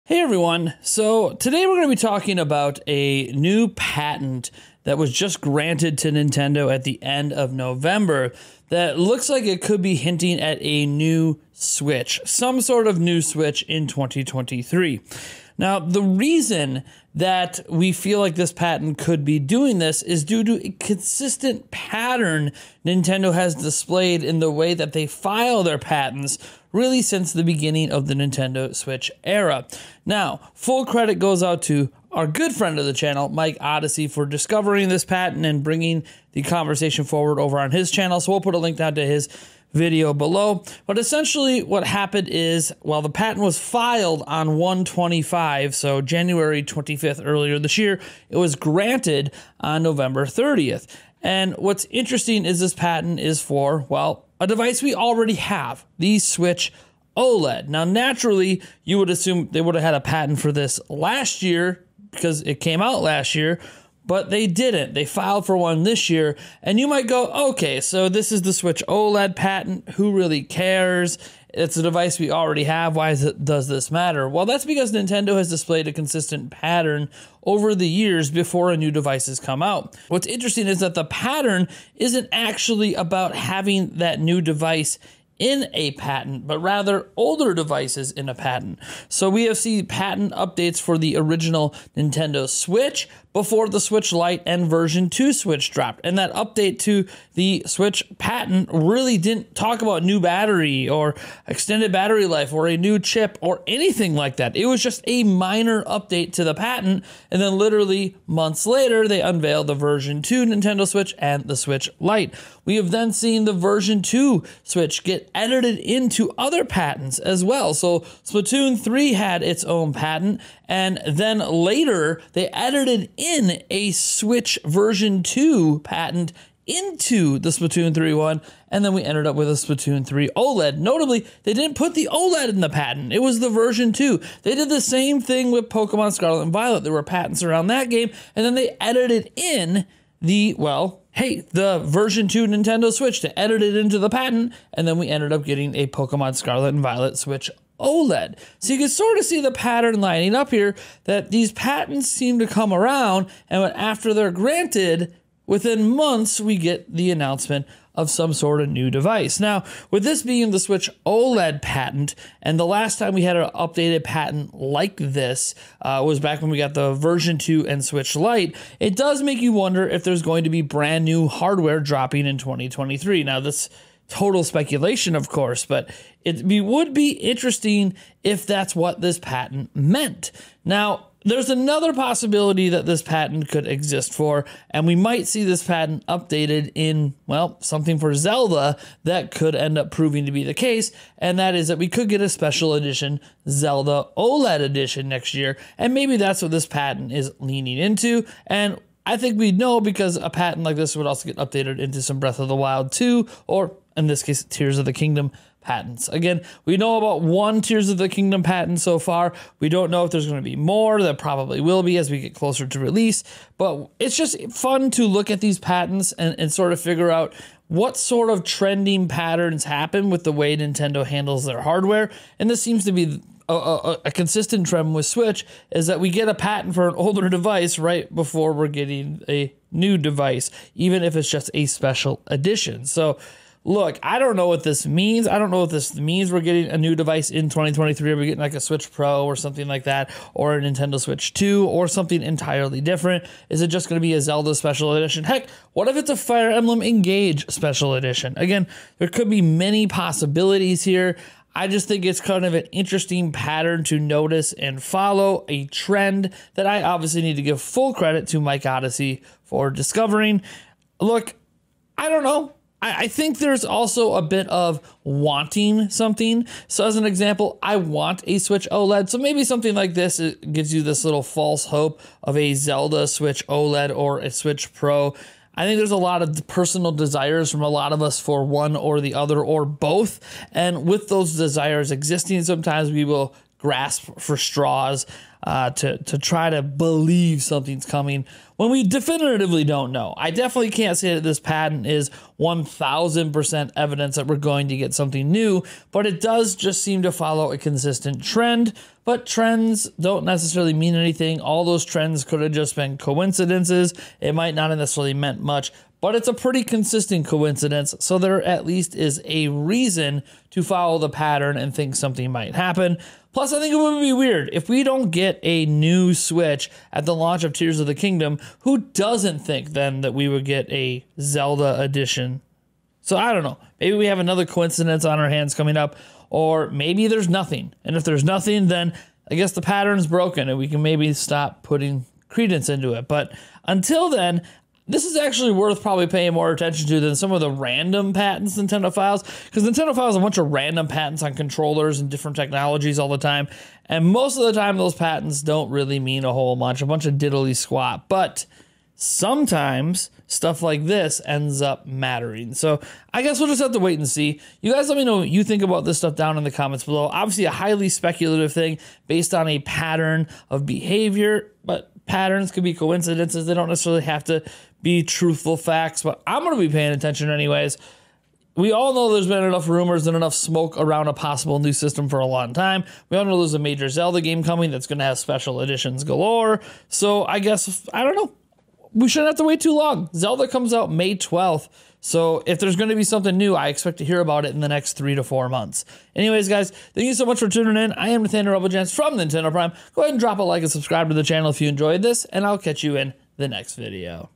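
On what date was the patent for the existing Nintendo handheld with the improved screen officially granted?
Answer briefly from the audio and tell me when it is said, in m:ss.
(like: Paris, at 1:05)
November 30, at 0:49.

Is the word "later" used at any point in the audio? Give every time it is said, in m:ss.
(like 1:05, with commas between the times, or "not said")
1:48, 2:01.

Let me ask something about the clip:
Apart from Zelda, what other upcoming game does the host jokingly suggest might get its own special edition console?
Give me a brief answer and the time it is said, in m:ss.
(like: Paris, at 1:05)
Fire Emblem Engage, at 4:06.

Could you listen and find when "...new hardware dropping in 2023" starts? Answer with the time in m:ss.
2:51.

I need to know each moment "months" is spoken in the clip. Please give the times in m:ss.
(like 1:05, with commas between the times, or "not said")
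1:48, 2:35, 6:25.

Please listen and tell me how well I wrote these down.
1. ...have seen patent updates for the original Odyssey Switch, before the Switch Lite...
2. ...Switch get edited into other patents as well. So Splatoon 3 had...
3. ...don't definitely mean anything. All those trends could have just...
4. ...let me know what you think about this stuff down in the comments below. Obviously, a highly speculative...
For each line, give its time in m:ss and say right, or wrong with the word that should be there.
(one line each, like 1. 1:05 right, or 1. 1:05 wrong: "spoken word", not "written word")
1. 1:29 wrong: "Nintendo", not "Odyssey"
2. 1:54 right
3. 4:59 wrong: "necessarily", not "definitely"
4. 5:54 right.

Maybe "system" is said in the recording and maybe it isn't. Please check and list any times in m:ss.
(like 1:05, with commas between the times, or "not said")
6:11.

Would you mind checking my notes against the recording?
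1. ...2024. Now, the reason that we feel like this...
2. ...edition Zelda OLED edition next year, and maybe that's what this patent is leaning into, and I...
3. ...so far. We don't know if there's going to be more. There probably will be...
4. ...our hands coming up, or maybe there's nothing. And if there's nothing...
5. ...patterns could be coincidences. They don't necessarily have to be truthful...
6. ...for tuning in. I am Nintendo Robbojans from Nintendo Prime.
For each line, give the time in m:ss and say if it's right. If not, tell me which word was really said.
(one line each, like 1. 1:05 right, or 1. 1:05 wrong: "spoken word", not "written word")
1. 0:13 wrong: "2023", not "2024"
2. 3:12 right
3. 3:28 right
4. 5:25 right
5. 6:02 right
6. 6:27 wrong: "Nathaniel", not "Nintendo".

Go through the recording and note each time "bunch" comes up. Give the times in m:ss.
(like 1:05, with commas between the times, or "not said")
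5:40, 5:46.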